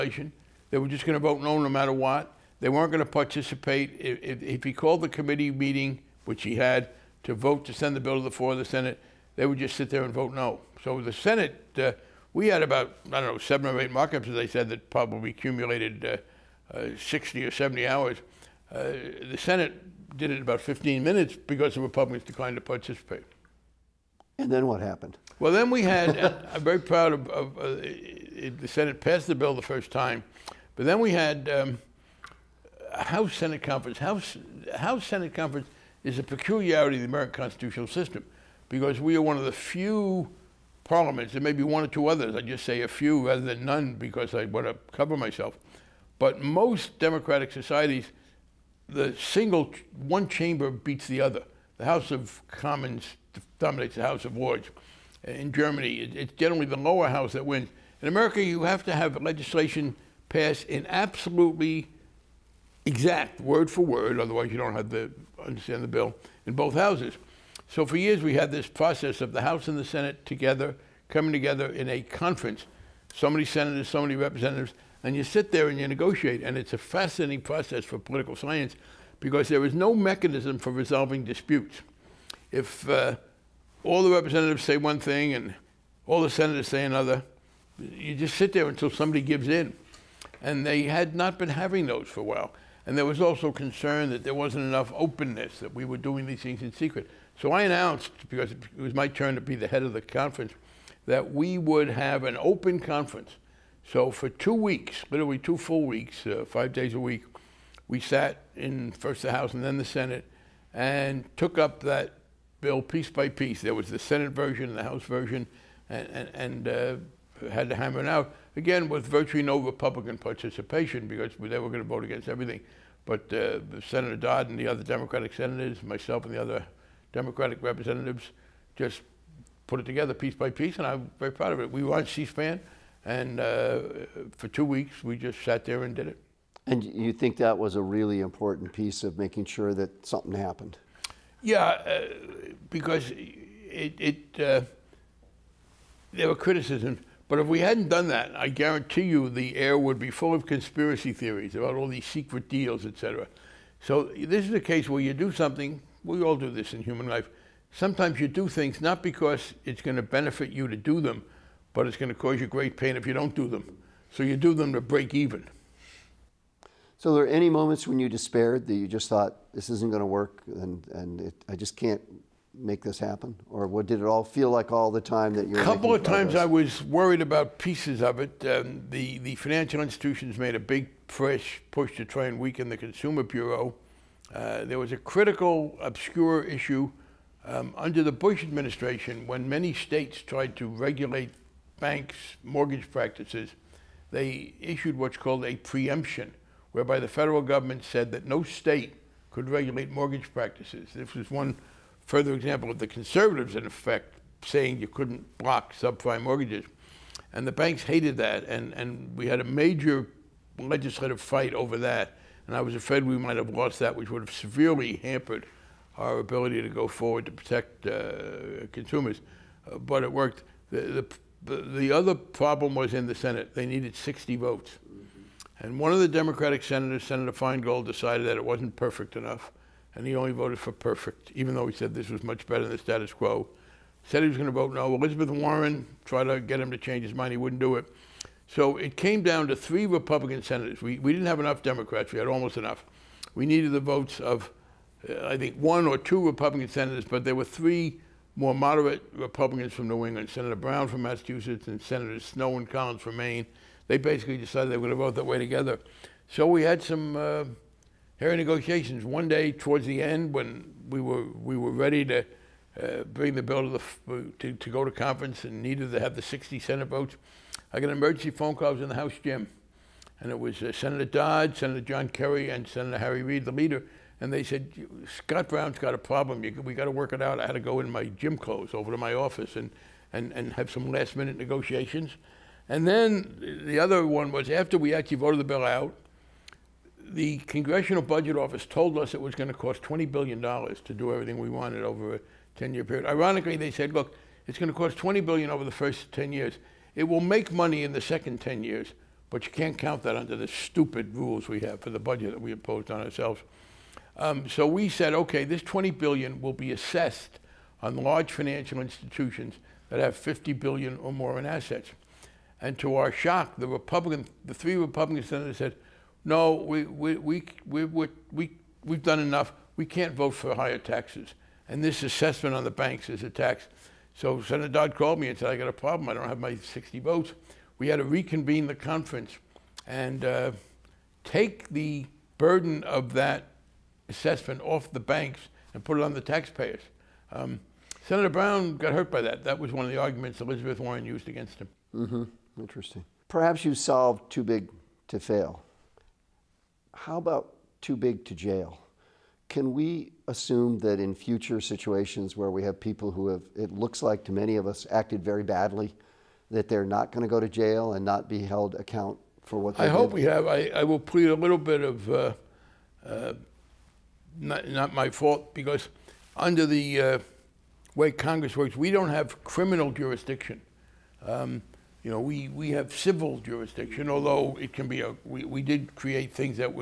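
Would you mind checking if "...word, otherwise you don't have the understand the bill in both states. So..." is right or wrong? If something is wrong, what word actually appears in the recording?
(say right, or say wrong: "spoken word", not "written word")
wrong: "houses", not "states".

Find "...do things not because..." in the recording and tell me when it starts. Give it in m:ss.
2:38.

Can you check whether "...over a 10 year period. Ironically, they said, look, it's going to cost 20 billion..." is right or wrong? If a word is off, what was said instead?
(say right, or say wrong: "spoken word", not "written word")
right.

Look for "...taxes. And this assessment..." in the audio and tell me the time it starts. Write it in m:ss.
5:20.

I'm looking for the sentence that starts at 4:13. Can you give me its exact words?
They basically decided they were going to vote that way together.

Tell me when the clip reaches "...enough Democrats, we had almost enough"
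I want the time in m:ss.
4:01.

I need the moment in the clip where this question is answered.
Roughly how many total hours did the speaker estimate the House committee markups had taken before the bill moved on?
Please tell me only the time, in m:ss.
0:16.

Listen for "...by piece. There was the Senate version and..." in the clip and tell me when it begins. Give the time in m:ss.
1:53.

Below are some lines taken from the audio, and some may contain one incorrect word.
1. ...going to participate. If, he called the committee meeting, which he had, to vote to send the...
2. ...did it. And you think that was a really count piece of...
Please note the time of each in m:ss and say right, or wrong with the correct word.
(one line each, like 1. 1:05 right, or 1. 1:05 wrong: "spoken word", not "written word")
1. 0:02 right
2. 2:15 wrong: "important", not "count".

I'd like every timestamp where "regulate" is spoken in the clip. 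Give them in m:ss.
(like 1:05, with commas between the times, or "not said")
3:10, 3:19.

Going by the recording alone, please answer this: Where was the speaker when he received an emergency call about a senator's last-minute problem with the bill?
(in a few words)
the House gym.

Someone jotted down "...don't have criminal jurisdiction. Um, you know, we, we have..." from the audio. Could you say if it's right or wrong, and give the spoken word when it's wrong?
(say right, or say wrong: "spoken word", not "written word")
right.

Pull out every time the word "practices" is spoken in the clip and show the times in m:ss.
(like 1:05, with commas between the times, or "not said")
3:12, 3:20.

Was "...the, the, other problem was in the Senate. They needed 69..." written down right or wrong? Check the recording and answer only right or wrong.
wrong.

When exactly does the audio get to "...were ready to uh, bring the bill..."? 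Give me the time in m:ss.
4:21.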